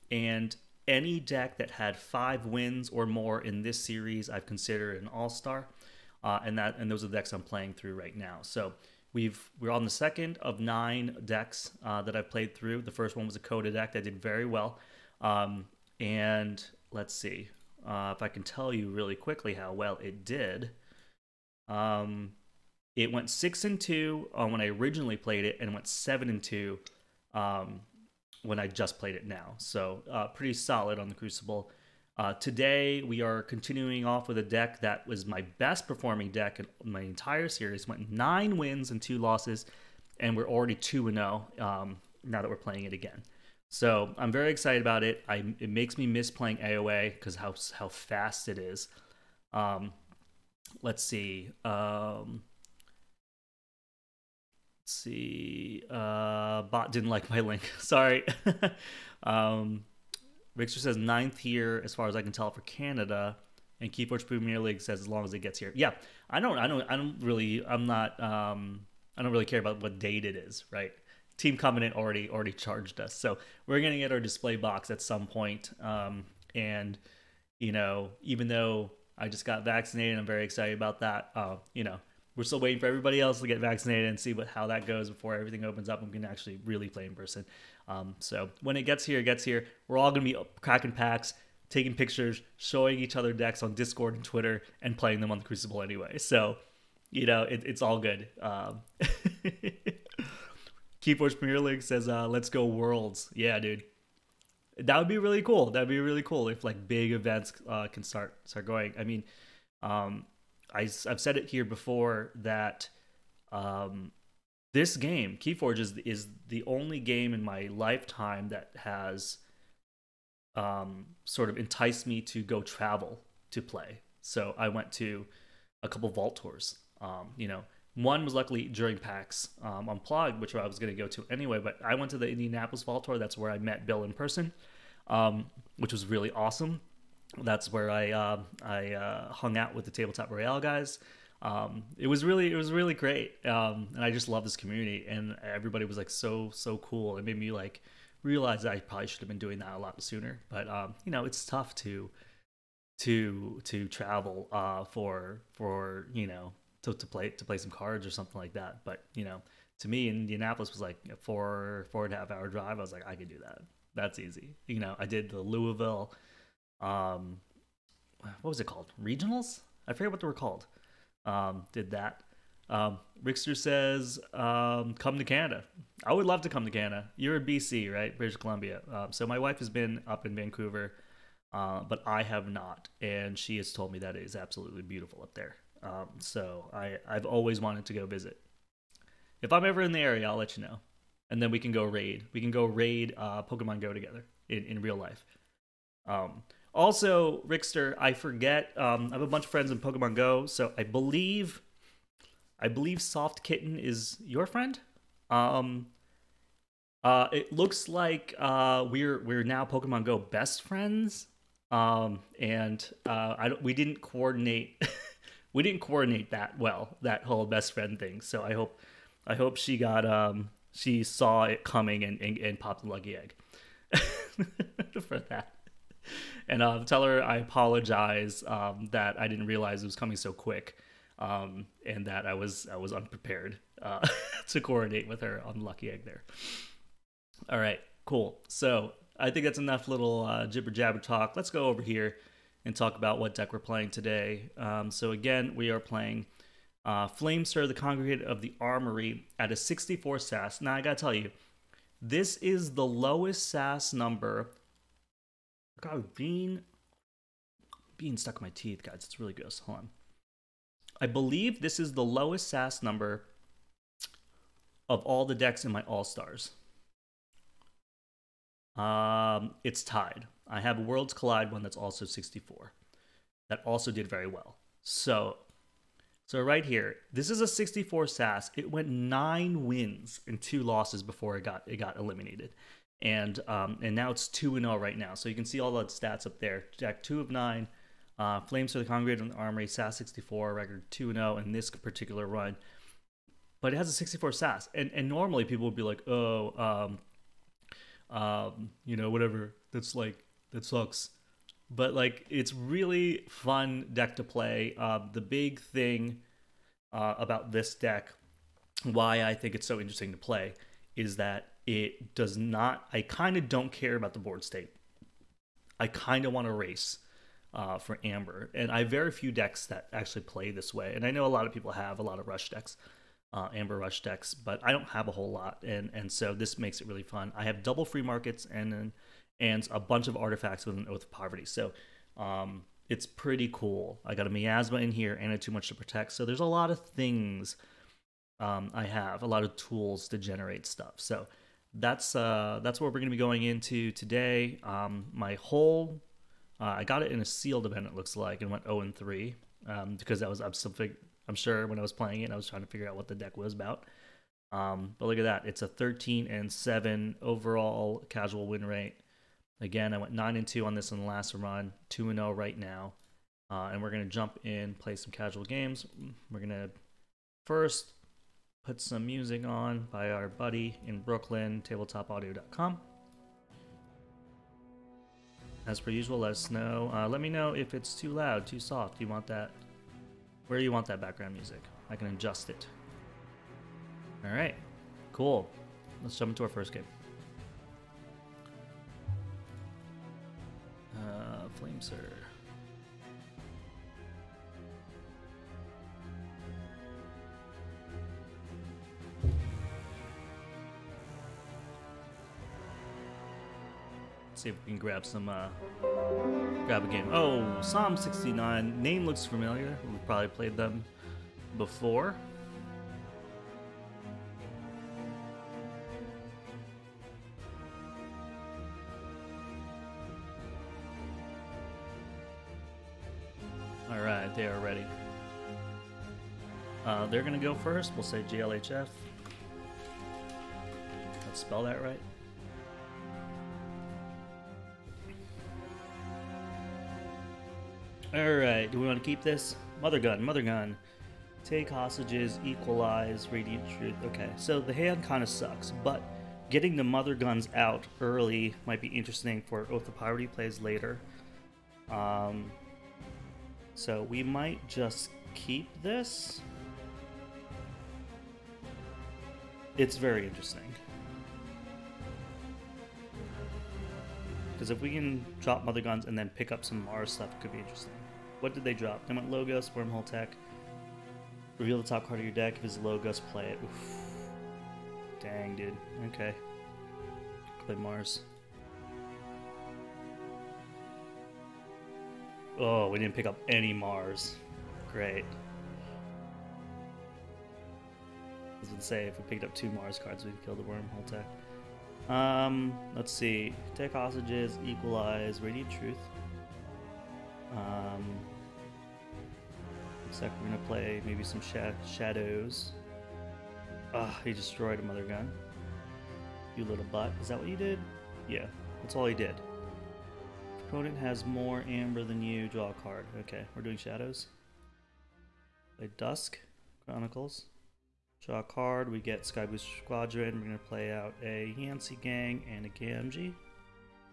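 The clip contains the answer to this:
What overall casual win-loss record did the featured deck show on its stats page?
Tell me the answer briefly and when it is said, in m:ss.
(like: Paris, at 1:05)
13 and 7, at 5:55.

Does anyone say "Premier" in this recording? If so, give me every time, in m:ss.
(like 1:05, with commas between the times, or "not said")
1:04, 1:41.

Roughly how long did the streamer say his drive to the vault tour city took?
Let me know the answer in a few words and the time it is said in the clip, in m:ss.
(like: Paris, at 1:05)
4 and a half hours, at 2:41.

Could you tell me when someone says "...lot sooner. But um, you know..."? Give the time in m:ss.
2:29.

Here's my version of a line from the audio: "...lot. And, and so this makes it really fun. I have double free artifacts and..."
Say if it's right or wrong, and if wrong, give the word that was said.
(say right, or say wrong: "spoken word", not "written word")
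wrong: "markets", not "artifacts".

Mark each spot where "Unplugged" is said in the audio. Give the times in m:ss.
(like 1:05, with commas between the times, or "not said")
2:09.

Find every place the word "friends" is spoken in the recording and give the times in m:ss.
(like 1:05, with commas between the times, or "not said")
3:19, 3:24, 3:30, 3:37.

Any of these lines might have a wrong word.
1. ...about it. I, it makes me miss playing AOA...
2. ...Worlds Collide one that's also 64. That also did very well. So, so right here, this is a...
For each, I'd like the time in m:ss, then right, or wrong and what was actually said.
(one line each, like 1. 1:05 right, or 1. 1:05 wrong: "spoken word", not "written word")
1. 0:44 right
2. 4:30 right.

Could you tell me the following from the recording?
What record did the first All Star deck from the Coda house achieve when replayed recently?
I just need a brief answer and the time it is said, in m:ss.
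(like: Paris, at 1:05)
7 and 2, at 0:25.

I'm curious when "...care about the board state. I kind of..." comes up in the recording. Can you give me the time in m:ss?
5:13.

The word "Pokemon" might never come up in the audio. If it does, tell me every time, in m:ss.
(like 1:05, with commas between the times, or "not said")
3:13, 3:19, 3:29.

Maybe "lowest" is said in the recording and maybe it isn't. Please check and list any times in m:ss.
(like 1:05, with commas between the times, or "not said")
4:12, 4:22.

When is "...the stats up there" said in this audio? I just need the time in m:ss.
4:45.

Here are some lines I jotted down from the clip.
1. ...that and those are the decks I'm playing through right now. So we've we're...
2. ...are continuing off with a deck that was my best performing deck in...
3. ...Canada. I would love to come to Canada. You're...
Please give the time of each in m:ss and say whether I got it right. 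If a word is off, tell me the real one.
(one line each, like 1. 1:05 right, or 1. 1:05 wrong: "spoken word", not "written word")
1. 0:06 right
2. 0:33 right
3. 2:55 right.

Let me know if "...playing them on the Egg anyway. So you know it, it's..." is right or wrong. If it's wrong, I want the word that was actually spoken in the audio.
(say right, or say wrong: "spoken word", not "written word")
wrong: "Crucible", not "Egg".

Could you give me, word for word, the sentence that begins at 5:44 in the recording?
Um, my whole, uh, I got it in a sealed event.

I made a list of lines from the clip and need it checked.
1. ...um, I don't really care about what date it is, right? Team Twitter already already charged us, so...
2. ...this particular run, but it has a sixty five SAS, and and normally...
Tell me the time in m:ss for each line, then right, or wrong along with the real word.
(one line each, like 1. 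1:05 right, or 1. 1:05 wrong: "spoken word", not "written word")
1. 1:08 wrong: "Covenant", not "Twitter"
2. 4:51 wrong: "four", not "five".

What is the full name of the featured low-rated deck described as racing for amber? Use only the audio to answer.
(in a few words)
Stir, the Congregate of the Armory.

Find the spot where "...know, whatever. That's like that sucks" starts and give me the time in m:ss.
4:58.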